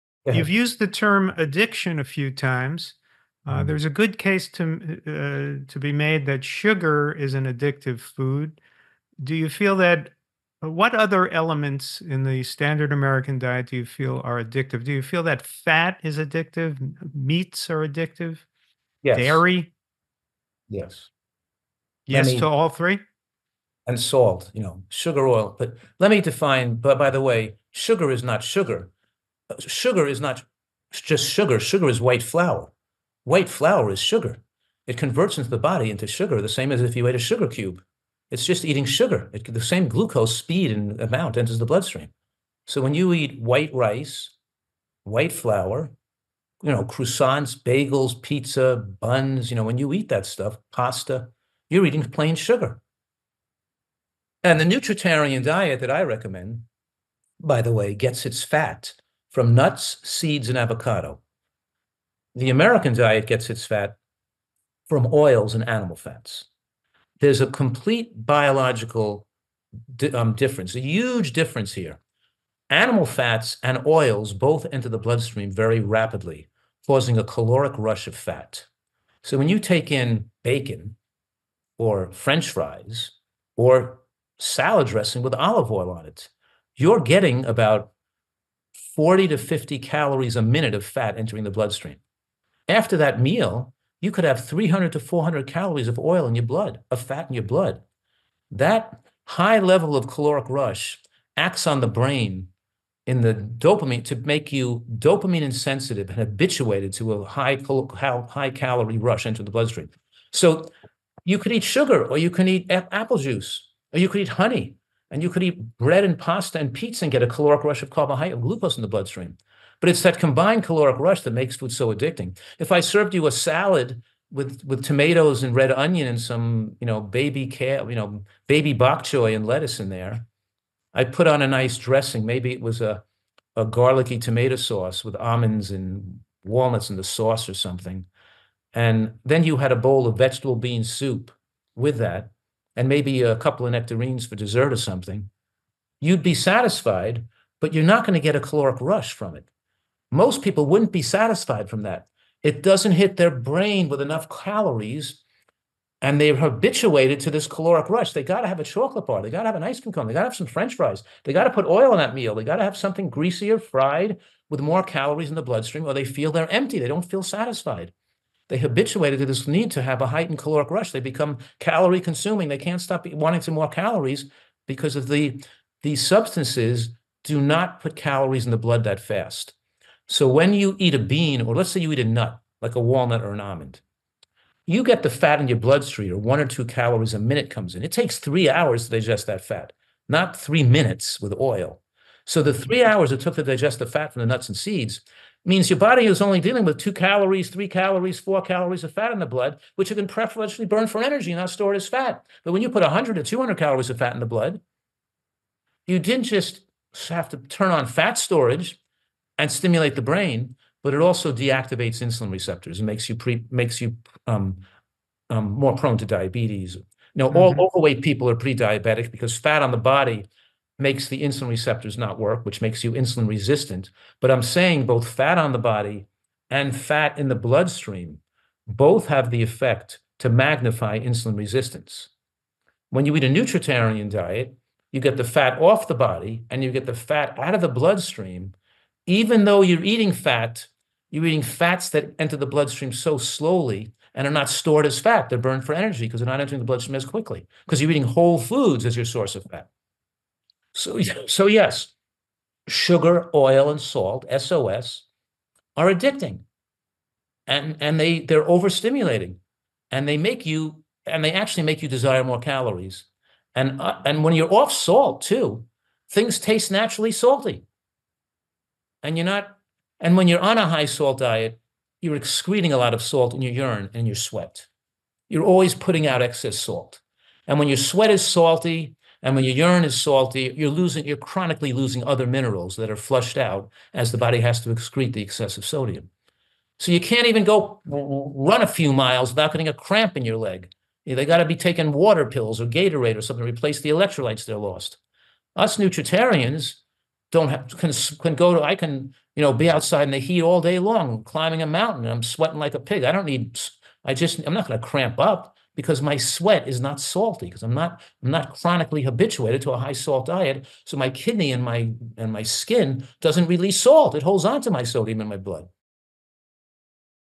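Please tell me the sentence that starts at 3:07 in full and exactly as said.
It takes three hours to digest that fat, not three minutes with oil.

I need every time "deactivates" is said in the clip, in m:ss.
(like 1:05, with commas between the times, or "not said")
3:31.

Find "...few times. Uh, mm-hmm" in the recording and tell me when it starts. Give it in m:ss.
0:02.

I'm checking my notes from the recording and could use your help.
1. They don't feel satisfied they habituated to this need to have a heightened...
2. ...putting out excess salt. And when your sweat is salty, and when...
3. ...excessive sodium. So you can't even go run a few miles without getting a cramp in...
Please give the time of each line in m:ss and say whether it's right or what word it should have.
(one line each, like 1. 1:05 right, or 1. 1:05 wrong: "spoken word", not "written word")
1. 2:46 right
2. 4:35 right
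3. 4:45 right.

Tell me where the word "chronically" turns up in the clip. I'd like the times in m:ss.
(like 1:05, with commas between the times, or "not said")
4:41, 5:08.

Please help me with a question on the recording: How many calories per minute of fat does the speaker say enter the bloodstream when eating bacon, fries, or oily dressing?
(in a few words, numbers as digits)
40 to 50.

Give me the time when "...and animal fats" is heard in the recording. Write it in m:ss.
1:05.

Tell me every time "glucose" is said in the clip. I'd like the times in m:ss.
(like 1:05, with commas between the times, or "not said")
0:39, 1:58.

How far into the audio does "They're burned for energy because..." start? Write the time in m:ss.
4:05.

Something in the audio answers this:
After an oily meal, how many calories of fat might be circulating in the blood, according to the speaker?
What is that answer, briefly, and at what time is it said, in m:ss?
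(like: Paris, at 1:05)
300 to 400, at 1:34.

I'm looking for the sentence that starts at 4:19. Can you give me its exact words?
And they make you and they actually make you desire more calories.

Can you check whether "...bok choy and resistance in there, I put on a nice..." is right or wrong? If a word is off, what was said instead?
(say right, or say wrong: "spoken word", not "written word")
wrong: "lettuce", not "resistance".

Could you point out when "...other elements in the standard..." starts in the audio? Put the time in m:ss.
0:10.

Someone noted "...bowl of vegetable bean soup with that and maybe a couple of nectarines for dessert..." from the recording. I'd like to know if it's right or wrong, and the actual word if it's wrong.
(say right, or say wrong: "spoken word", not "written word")
right.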